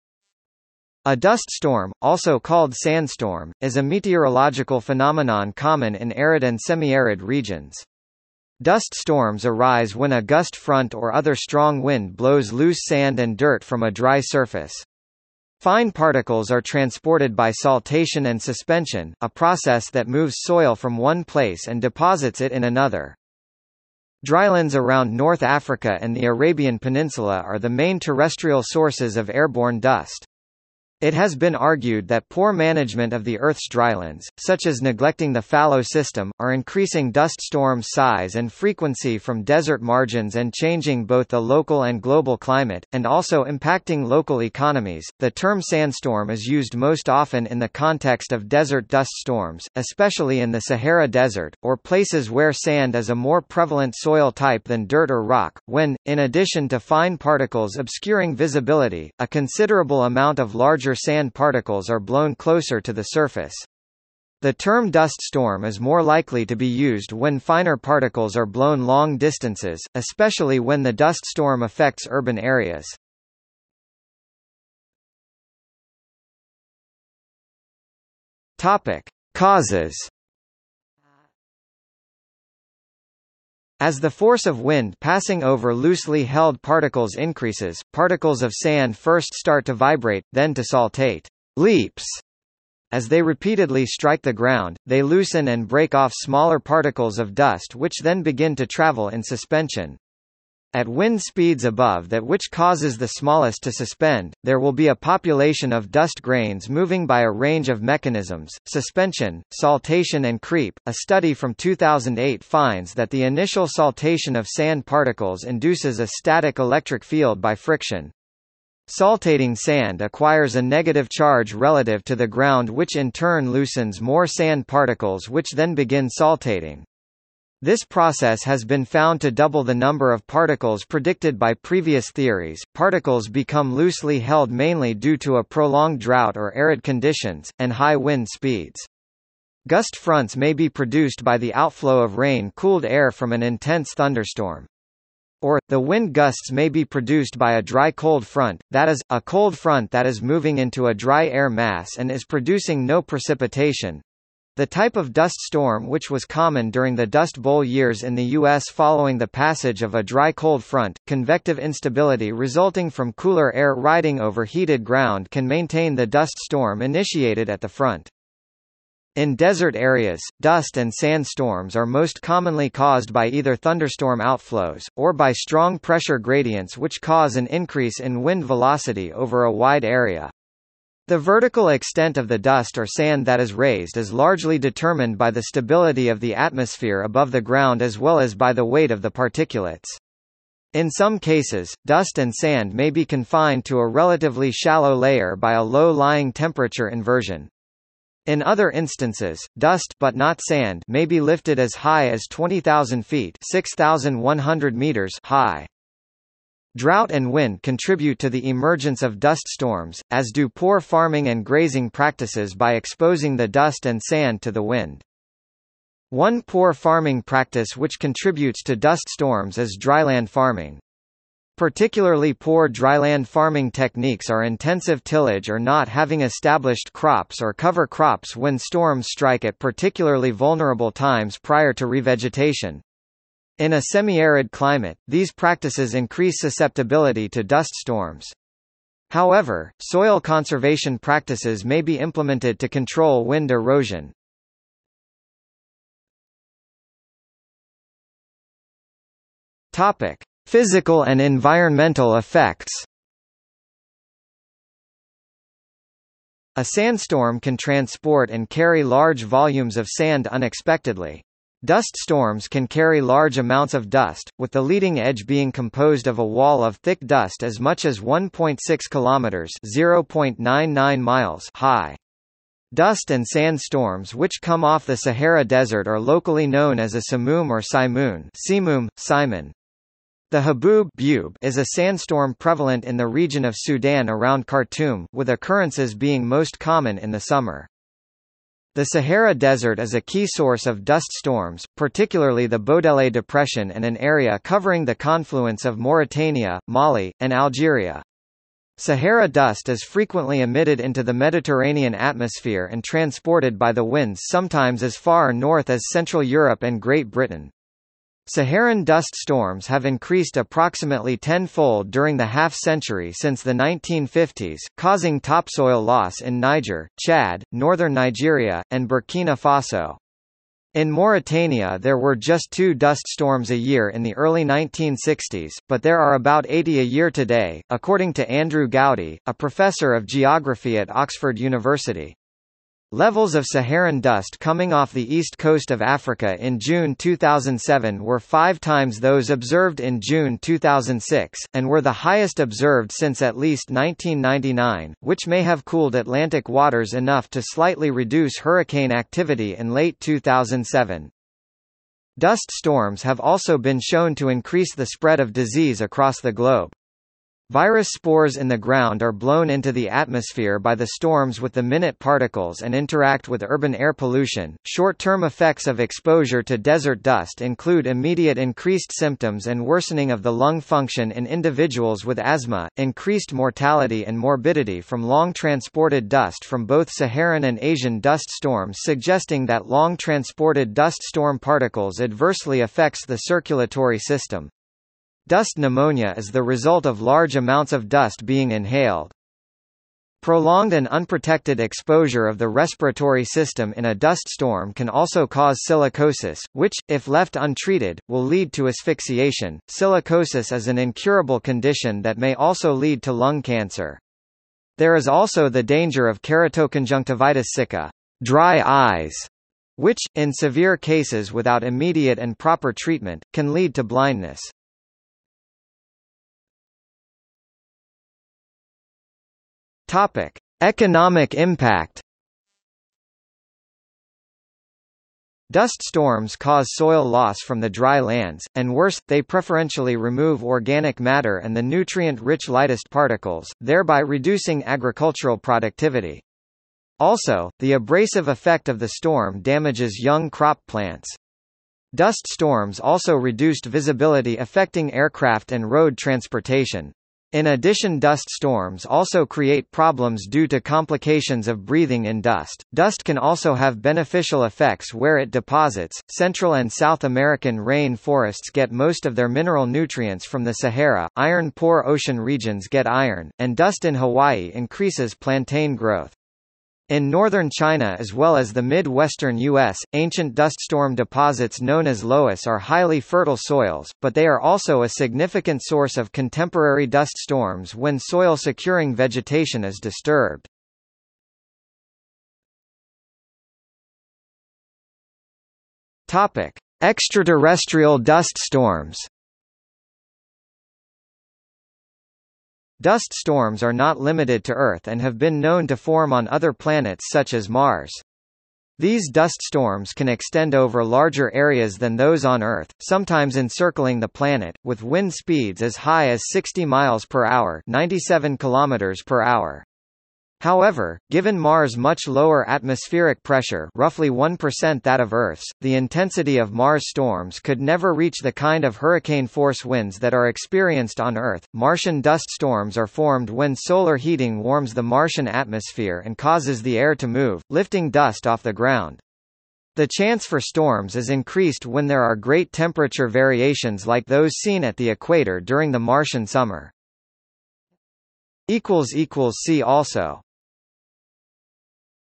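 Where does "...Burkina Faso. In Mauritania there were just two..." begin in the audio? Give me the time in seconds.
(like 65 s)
318 s.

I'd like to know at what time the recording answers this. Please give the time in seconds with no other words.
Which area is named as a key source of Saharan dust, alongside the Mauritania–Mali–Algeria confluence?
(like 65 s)
292 s.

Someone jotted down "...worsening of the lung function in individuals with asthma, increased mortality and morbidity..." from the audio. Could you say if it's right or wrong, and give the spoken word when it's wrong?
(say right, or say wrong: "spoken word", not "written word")
right.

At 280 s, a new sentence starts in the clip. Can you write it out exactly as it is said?
The haboob is a sandstorm prevalent in the region of Sudan around Khartoum, with occurrences being most common in the summer.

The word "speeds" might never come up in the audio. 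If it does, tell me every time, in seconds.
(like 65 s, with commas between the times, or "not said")
101 s, 138 s, 505 s.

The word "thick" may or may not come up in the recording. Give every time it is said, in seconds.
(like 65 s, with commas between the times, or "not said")
266 s.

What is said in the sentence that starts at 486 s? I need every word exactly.
Extraterrestrial dust storms Dust storms are not limited to Earth and have been known to form on other planets such as Mars.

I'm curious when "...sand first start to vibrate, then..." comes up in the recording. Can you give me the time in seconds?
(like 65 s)
88 s.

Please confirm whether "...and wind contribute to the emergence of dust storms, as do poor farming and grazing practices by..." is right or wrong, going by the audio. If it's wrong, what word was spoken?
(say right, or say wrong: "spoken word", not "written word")
right.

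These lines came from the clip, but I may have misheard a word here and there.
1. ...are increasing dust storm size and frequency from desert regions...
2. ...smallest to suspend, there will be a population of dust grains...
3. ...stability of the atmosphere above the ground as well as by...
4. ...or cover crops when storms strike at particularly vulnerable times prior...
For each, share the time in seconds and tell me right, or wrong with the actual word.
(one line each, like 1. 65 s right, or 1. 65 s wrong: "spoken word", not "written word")
1. 36 s wrong: "margins", not "regions"
2. 103 s right
3. 185 s right
4. 227 s right.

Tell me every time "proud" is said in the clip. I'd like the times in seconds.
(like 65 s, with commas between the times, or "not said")
not said.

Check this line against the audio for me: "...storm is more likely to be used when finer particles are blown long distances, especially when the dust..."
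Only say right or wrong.
right.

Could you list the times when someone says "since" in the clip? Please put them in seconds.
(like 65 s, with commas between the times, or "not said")
313 s, 342 s.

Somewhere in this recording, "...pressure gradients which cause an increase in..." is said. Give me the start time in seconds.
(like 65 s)
175 s.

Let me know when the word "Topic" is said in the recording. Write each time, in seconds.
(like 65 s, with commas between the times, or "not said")
78 s, 249 s, 419 s.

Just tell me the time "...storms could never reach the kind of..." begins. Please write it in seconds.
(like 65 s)
516 s.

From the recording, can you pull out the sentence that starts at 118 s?
Saltating sand acquires a negative charge relative to the ground which in turn loosens more sand particles which then begin saltating.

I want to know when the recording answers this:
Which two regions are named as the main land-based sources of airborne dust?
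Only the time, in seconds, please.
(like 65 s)
25 s.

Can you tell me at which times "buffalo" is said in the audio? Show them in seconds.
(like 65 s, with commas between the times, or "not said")
not said.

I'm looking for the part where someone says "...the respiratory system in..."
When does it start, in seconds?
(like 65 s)
392 s.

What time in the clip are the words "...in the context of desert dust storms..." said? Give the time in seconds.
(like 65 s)
47 s.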